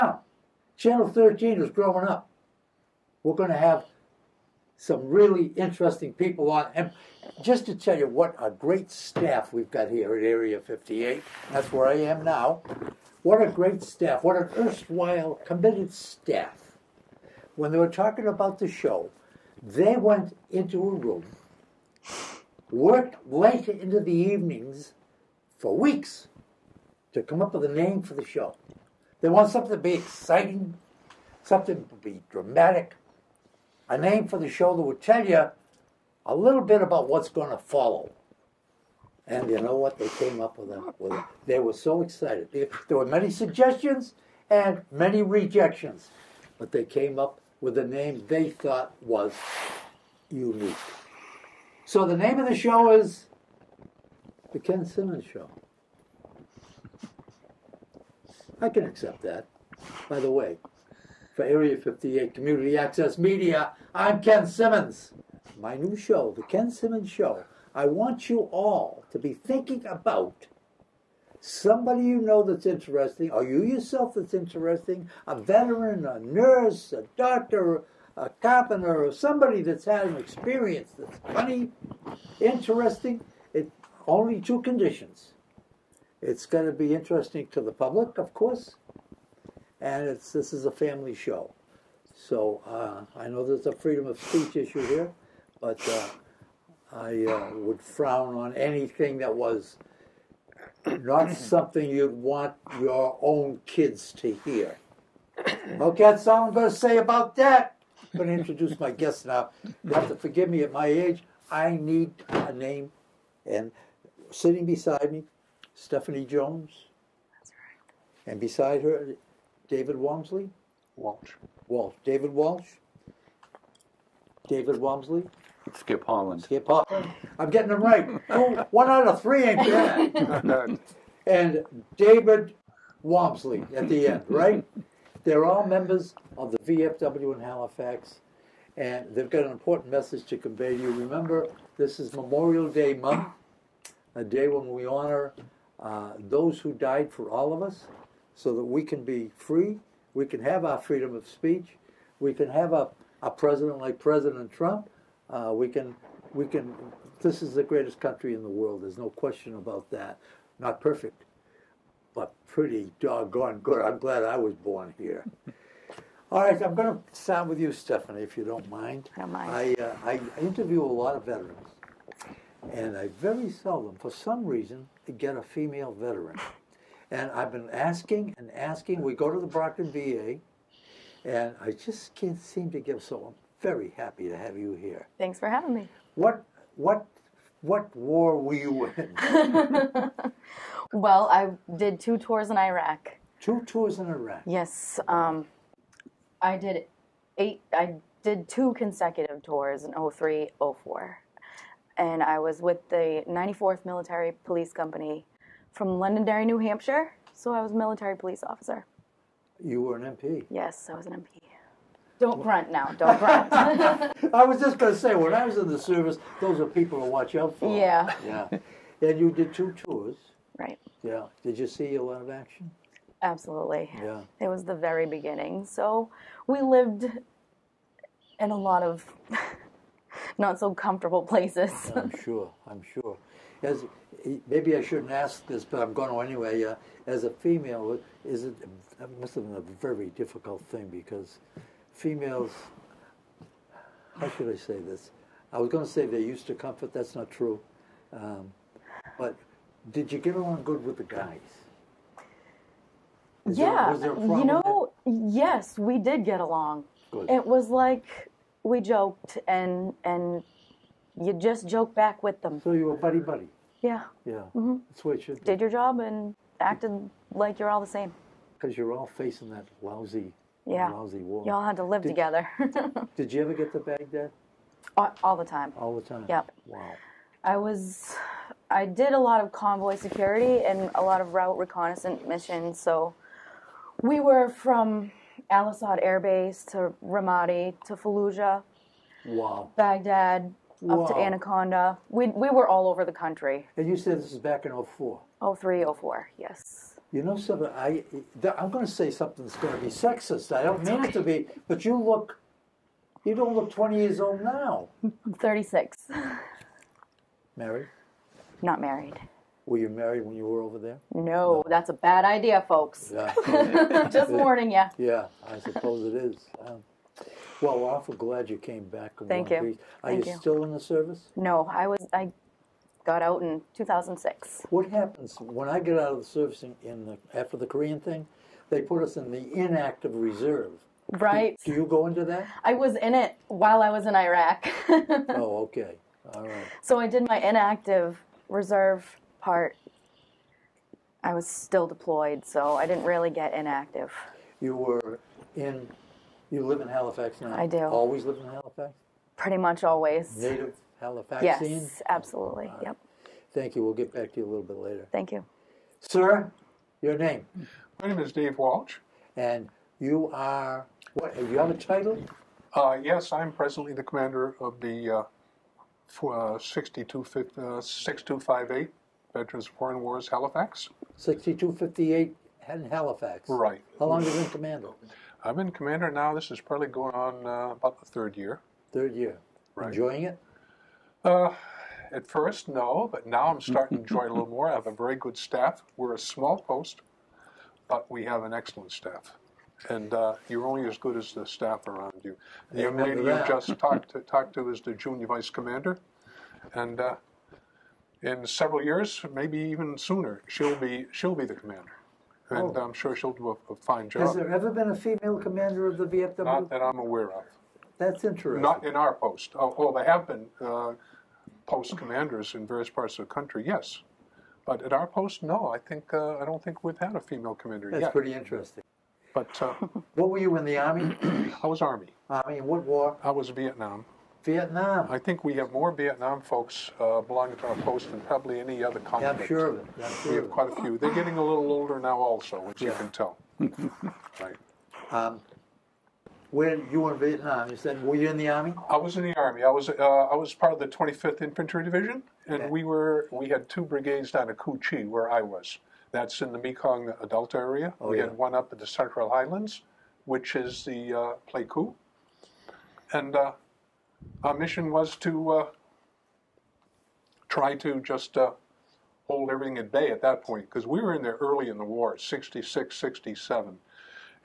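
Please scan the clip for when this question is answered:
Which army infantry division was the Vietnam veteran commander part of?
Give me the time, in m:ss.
7:20.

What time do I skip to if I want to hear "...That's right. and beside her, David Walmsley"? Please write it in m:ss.
1:57.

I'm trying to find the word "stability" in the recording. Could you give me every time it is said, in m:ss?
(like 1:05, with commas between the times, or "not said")
not said.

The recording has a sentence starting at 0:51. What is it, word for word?
So the name of the show is The Ken Simmons Show.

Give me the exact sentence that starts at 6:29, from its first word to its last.
And uh, you're only as good as the staff around you.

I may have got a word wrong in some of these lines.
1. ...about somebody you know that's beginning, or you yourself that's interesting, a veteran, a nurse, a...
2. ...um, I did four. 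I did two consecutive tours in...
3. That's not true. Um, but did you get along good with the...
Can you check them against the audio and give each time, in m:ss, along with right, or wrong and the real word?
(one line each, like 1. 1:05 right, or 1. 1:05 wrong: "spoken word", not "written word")
1. 1:09 wrong: "interesting", not "beginning"
2. 3:15 wrong: "eight", not "four"
3. 4:06 right.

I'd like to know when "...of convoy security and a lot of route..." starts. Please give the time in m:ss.
4:39.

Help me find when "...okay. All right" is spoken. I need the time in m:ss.
5:35.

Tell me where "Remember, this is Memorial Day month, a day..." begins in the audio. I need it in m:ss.
2:20.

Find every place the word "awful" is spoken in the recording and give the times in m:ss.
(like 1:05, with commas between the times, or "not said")
5:17.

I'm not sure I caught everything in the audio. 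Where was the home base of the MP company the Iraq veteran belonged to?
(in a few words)
Londonderry, New Hampshire.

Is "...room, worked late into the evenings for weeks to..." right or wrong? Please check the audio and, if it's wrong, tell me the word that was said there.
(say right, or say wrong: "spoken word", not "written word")
right.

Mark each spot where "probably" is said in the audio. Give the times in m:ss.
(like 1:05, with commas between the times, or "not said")
6:16, 7:08.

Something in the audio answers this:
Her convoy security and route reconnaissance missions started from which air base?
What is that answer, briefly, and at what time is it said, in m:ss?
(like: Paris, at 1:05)
Al Asad Air Base, at 4:45.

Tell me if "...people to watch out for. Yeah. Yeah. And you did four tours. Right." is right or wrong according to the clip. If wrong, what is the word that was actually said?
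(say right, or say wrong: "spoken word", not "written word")
wrong: "two", not "four".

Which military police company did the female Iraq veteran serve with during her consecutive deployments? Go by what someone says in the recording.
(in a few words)
94th Military Police Company.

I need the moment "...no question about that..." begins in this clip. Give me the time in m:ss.
2:38.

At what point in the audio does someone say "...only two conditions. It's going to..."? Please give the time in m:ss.
1:24.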